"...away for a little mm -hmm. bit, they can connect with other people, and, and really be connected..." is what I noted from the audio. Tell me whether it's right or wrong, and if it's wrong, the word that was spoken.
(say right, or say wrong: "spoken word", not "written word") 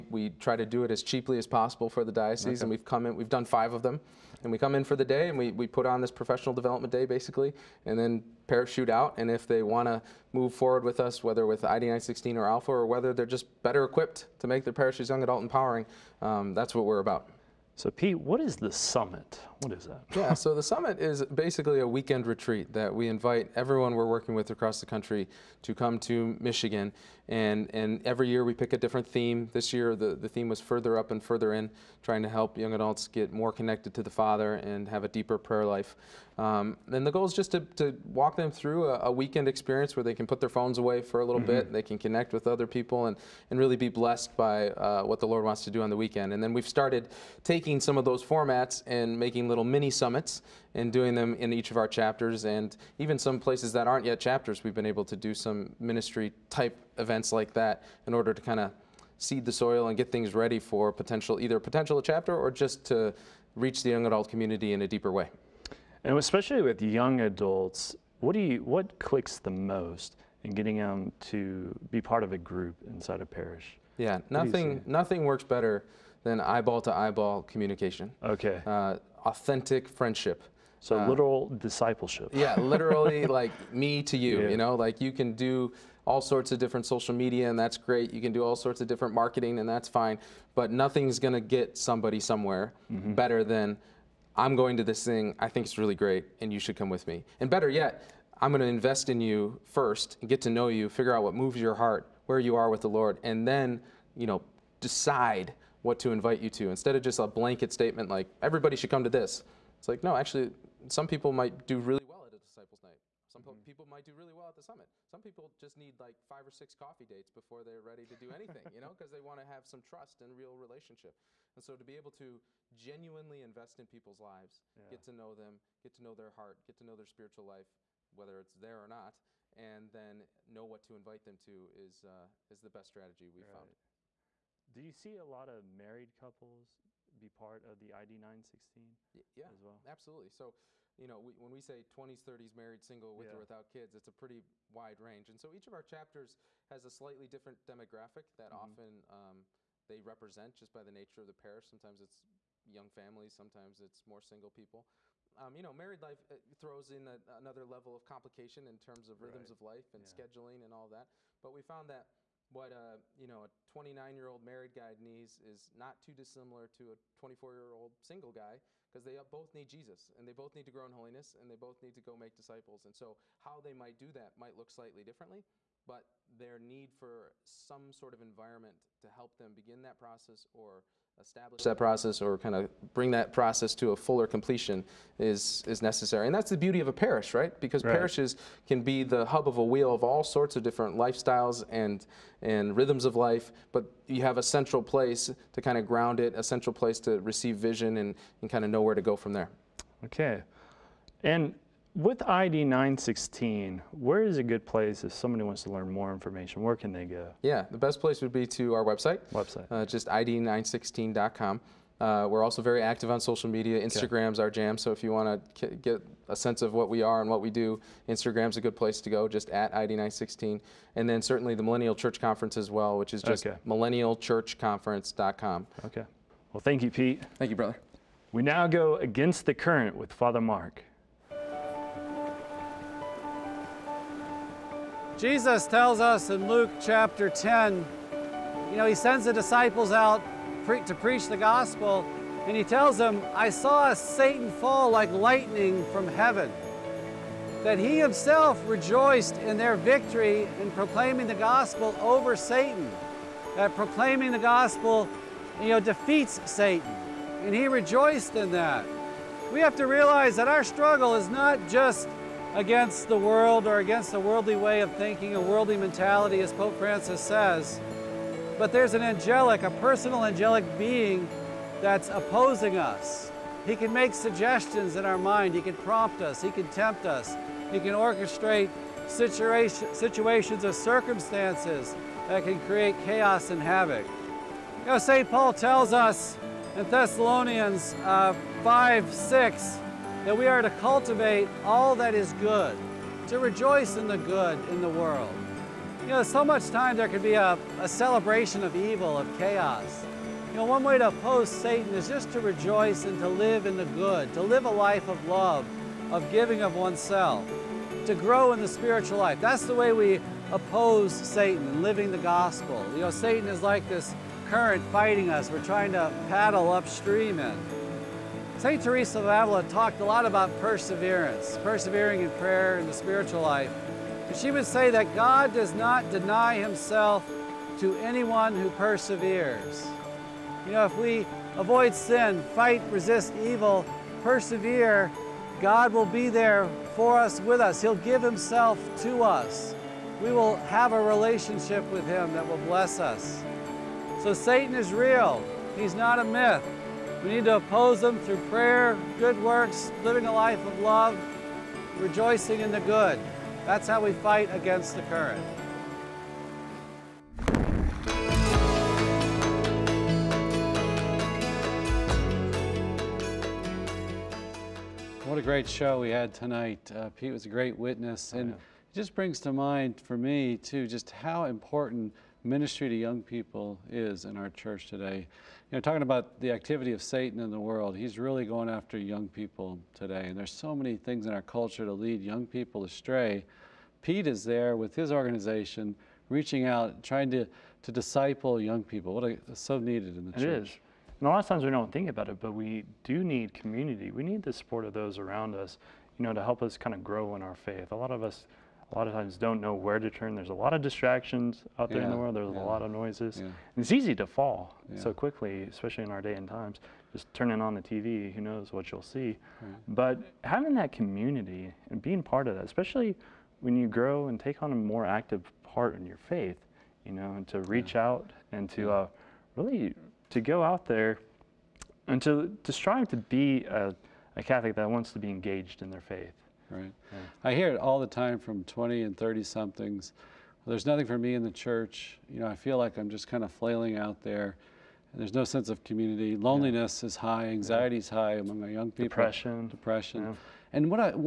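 wrong: "blessed", not "connected".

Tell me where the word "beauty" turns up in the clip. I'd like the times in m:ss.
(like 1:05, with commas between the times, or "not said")
3:06.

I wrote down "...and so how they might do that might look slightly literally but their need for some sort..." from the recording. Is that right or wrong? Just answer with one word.
wrong.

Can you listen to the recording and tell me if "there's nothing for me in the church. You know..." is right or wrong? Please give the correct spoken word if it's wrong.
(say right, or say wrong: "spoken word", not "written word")
right.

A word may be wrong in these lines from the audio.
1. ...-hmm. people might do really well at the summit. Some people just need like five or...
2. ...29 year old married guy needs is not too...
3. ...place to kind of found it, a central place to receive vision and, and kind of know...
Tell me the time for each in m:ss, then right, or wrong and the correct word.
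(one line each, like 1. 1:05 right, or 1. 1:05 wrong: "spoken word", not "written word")
1. 1:53 right
2. 2:43 right
3. 3:14 wrong: "ground", not "found".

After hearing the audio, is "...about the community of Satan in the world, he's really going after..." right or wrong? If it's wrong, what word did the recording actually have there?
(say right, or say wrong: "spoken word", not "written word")
wrong: "activity", not "community".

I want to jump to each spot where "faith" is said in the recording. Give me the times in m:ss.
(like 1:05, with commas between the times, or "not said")
6:37, 6:56, 7:06.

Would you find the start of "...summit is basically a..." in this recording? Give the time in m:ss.
0:20.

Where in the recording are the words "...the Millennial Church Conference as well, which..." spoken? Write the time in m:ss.
3:41.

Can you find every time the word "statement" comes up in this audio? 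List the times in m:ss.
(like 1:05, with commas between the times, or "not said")
1:47.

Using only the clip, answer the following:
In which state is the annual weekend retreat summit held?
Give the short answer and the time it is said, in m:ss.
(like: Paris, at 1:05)
Michigan, at 0:26.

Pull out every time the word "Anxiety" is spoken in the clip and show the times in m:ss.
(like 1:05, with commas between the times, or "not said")
7:17.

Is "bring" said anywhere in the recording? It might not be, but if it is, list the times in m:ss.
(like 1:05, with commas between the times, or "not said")
3:02, 6:09.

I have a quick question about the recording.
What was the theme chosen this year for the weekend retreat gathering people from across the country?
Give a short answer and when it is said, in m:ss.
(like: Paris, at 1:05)
Further up and further in, at 0:30.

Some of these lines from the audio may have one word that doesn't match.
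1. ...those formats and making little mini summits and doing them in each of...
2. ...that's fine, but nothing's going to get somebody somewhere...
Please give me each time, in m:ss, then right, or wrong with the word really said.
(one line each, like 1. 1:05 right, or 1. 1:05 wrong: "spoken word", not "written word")
1. 0:48 right
2. 1:29 right.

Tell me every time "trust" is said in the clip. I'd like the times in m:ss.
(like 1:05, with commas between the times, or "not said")
1:59.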